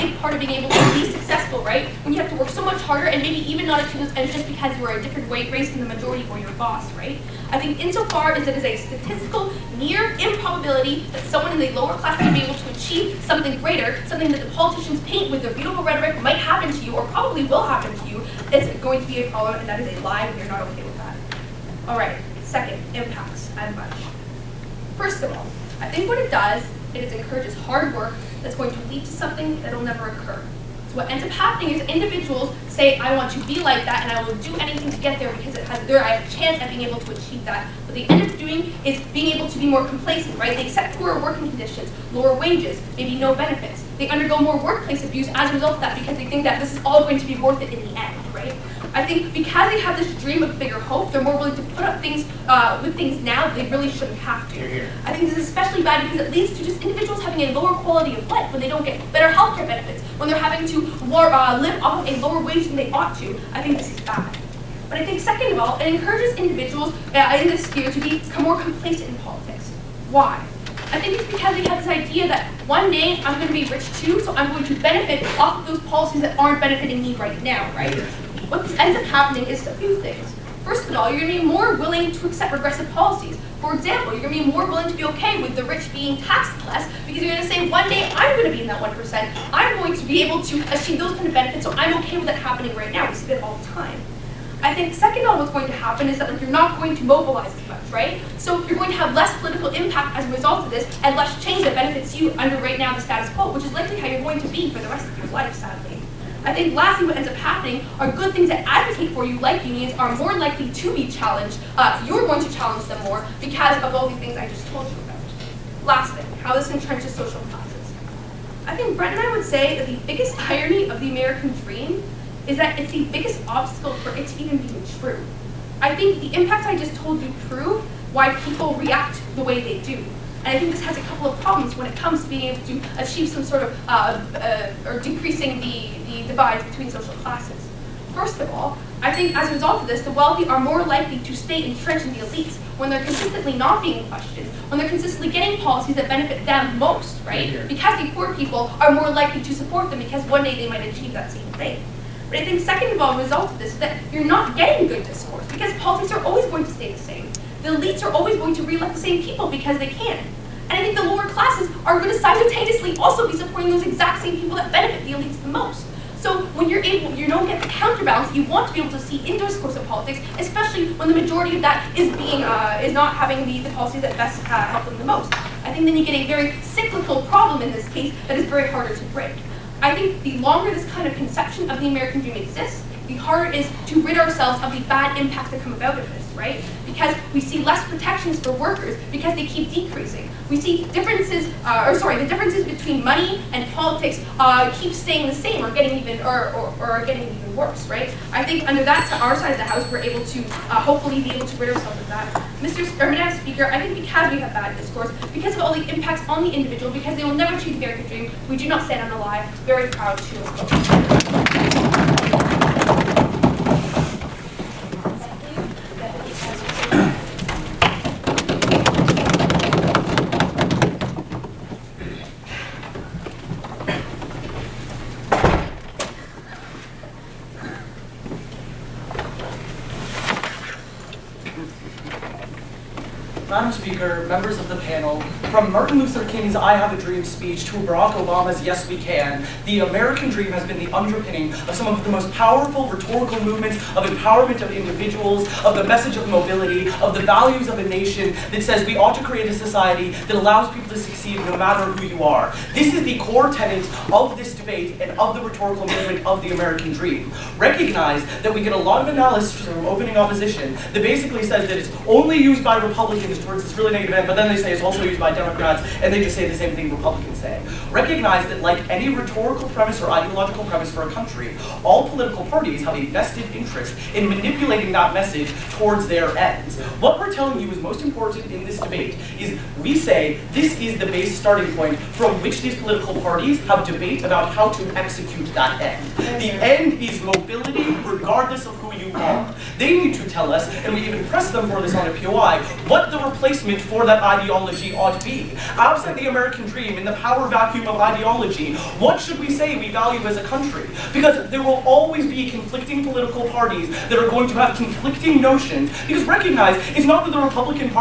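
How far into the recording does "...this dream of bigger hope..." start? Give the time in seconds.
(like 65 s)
49 s.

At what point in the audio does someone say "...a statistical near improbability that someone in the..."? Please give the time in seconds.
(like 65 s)
8 s.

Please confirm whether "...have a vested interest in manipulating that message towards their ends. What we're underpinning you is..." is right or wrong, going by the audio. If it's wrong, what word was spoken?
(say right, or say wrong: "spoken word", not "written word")
wrong: "telling", not "underpinning".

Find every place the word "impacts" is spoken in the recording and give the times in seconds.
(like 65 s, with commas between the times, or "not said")
22 s, 99 s, 126 s, 185 s, 205 s.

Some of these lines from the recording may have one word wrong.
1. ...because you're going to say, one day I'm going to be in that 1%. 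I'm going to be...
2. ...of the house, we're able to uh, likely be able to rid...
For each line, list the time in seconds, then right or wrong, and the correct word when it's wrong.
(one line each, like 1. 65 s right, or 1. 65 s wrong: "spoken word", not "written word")
1. 87 s right
2. 199 s wrong: "hopefully", not "likely".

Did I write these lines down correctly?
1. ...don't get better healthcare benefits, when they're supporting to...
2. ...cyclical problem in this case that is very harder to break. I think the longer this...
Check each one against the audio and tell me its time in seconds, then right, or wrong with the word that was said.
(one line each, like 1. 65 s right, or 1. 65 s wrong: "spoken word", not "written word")
1. 58 s wrong: "having", not "supporting"
2. 176 s right.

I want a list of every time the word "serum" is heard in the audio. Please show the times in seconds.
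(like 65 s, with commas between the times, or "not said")
not said.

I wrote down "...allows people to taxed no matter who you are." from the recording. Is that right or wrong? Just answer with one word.
wrong.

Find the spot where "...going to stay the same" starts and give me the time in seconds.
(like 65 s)
156 s.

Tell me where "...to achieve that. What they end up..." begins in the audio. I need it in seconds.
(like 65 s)
36 s.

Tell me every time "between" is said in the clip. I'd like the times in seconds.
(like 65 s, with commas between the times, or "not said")
136 s, 192 s.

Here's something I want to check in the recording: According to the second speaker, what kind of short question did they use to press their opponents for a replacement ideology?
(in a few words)
POI.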